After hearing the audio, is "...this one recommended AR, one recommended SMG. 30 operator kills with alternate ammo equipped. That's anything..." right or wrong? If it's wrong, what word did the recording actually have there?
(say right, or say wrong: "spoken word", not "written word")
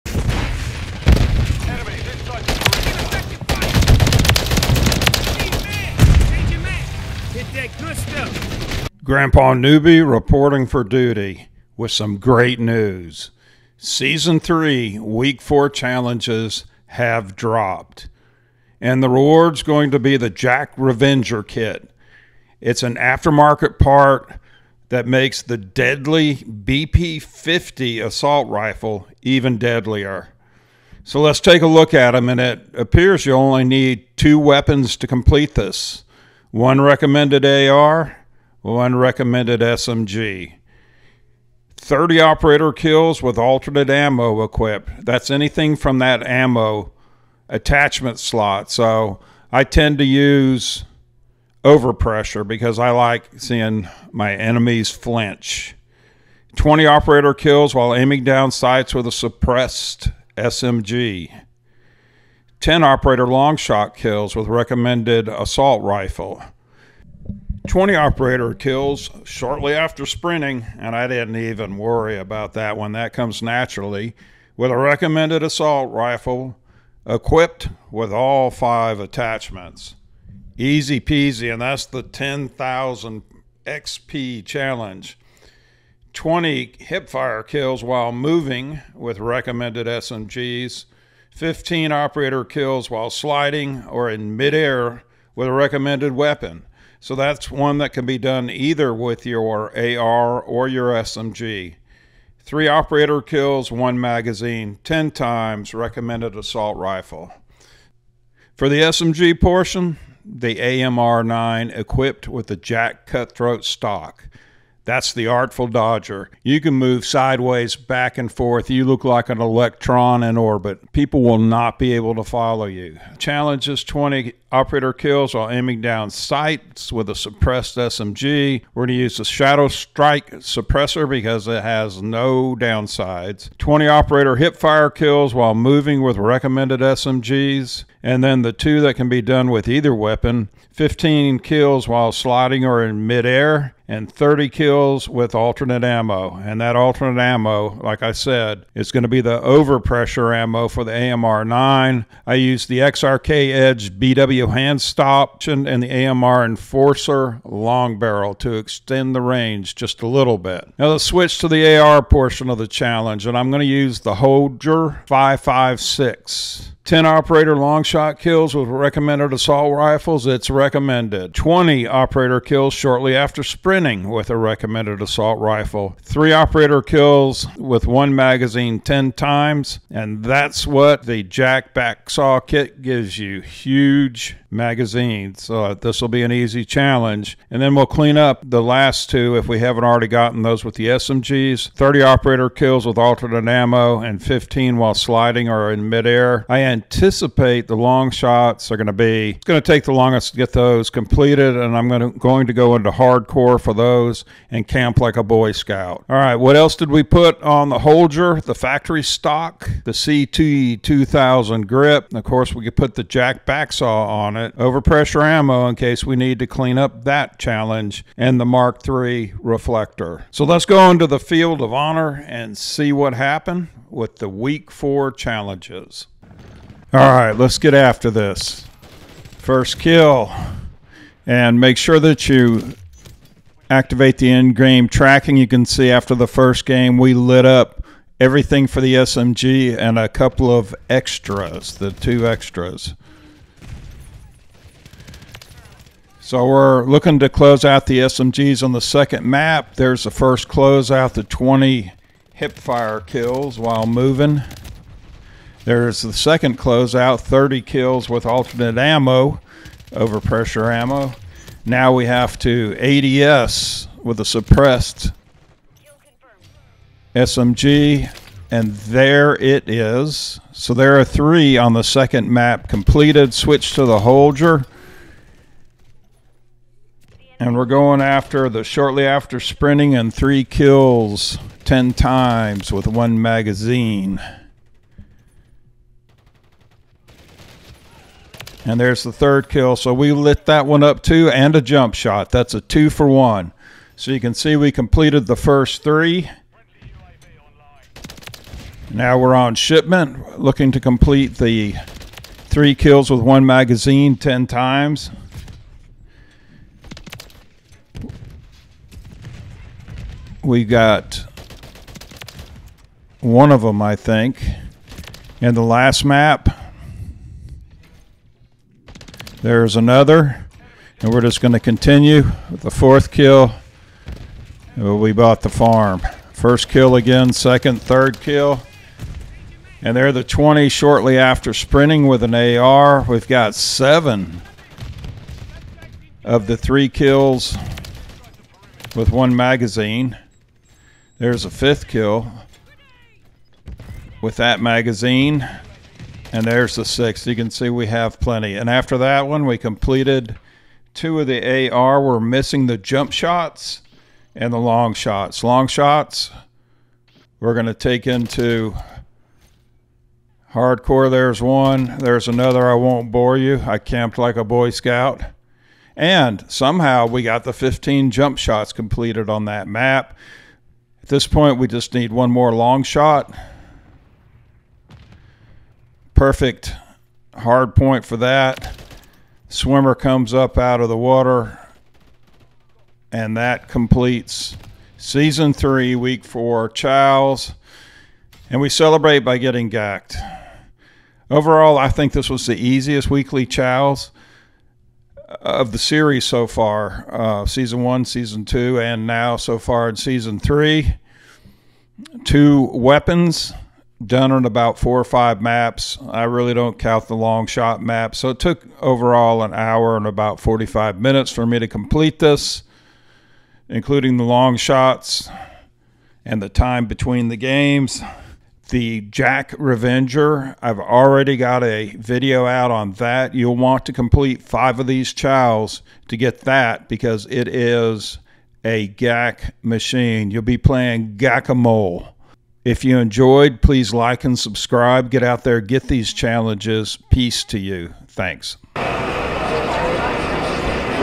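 right.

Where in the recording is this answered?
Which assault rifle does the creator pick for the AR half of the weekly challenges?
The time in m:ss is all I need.
2:44.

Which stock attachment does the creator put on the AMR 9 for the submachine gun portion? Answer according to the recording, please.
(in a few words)
JAK Cutthroat.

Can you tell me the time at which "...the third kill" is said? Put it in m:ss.
4:49.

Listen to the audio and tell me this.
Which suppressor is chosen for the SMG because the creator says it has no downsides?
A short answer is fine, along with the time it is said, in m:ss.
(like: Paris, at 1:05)
Shadow Strike, at 2:09.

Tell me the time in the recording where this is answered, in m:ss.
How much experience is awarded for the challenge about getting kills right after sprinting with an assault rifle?
1:22.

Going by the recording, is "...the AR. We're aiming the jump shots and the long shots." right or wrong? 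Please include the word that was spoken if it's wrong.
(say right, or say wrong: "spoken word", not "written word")
wrong: "missing", not "aiming".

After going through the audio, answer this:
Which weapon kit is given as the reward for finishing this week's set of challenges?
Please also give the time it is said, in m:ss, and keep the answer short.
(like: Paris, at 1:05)
JAK Revenger kit, at 0:20.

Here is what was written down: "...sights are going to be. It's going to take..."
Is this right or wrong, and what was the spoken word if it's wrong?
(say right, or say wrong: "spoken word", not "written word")
wrong: "shots", not "sights".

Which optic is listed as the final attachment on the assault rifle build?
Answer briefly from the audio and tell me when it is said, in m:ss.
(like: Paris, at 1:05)
Mark III reflector, at 3:38.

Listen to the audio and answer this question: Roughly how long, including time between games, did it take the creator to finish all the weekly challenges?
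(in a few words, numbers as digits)
An hour and 45 minutes.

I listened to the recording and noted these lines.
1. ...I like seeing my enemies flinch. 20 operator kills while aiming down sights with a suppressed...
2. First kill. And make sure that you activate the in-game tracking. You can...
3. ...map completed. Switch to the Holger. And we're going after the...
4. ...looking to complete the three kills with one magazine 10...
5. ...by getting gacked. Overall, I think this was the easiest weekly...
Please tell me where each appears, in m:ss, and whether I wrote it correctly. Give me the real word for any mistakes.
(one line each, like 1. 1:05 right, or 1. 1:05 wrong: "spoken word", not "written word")
1. 0:52 right
2. 3:49 right
3. 4:32 right
4. 5:00 right
5. 6:29 right.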